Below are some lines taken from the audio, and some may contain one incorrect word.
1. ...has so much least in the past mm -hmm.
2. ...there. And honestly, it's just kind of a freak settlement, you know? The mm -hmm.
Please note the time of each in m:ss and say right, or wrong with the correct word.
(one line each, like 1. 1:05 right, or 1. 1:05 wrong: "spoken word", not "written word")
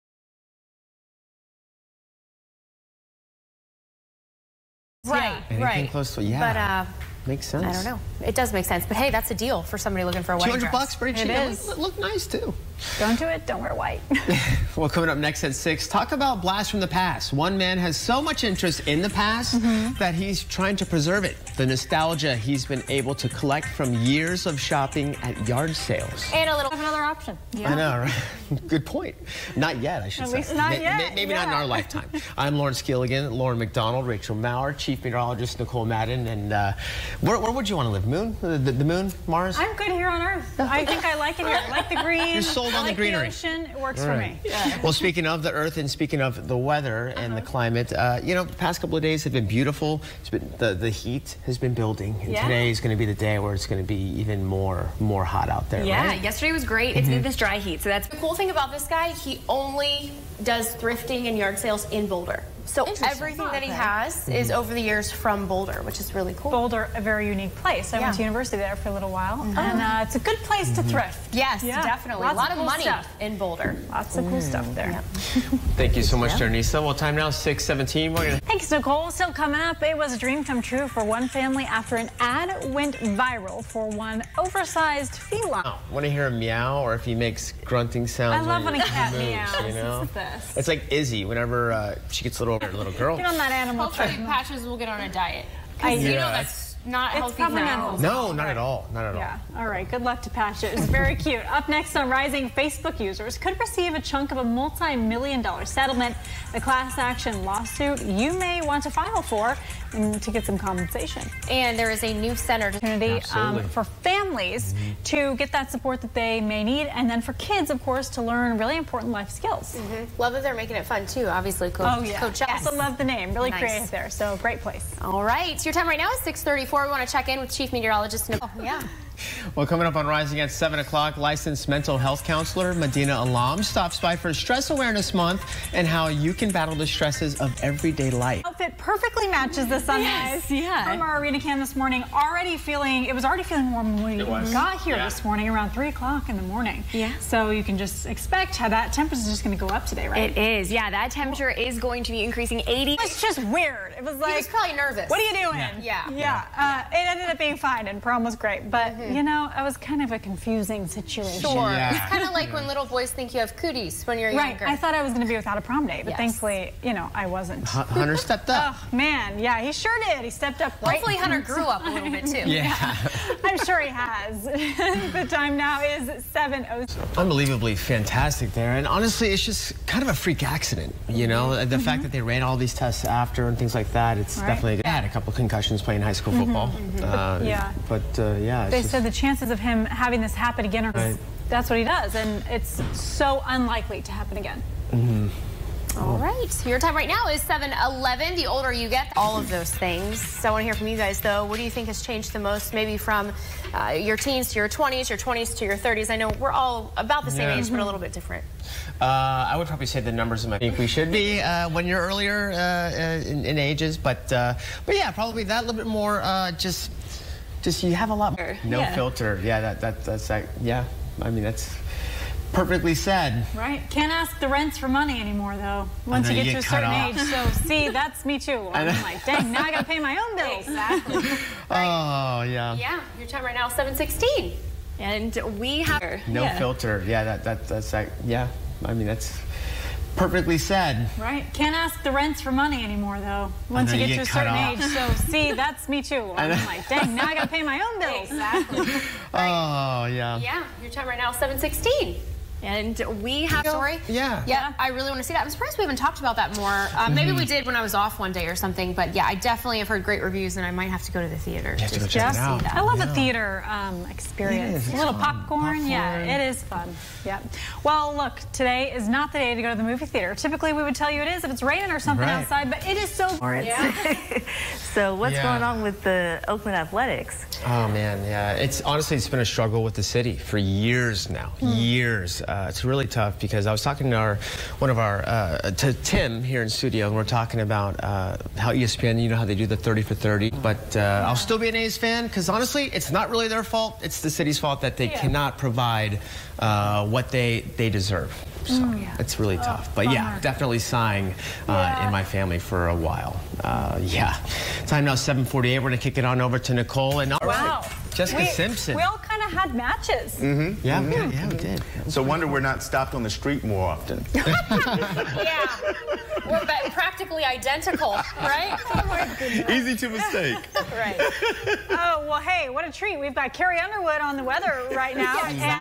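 1. 0:17 wrong: "interest", not "least"
2. 2:58 wrong: "accident", not "settlement".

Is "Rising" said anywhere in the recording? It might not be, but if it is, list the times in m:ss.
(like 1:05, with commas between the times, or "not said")
1:42, 2:10.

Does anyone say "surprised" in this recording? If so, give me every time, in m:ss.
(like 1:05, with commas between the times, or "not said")
4:15.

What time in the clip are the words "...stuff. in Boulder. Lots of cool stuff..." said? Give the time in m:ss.
1:12.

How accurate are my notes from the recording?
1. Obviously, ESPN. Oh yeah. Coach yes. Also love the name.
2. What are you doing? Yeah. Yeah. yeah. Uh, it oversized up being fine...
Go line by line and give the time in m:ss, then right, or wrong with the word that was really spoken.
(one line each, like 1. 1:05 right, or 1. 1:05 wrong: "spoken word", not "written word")
1. 2:01 wrong: "Coach", not "ESPN"
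2. 2:35 wrong: "ended", not "oversized".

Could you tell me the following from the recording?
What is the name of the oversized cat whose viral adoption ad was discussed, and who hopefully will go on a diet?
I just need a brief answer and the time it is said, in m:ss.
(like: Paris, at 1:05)
Patches, at 1:34.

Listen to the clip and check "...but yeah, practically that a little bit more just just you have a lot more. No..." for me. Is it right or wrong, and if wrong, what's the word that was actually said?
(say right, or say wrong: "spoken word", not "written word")
wrong: "probably", not "practically".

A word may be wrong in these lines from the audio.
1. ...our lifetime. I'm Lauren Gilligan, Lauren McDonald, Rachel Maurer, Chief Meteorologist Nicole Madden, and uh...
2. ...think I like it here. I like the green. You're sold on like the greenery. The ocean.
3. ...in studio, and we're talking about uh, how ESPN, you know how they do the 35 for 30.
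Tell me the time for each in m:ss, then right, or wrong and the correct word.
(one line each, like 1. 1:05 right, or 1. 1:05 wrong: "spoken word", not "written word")
1. 0:31 right
2. 0:40 right
3. 4:46 wrong: "30", not "35".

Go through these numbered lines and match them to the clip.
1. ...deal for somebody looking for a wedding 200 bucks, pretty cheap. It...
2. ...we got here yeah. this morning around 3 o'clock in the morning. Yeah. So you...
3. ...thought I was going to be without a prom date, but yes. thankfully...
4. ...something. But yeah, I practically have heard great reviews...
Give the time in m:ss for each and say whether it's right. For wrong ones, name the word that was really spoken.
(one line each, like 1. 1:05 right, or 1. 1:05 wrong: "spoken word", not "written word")
1. 0:09 right
2. 2:24 right
3. 2:44 right
4. 4:18 wrong: "definitely", not "practically".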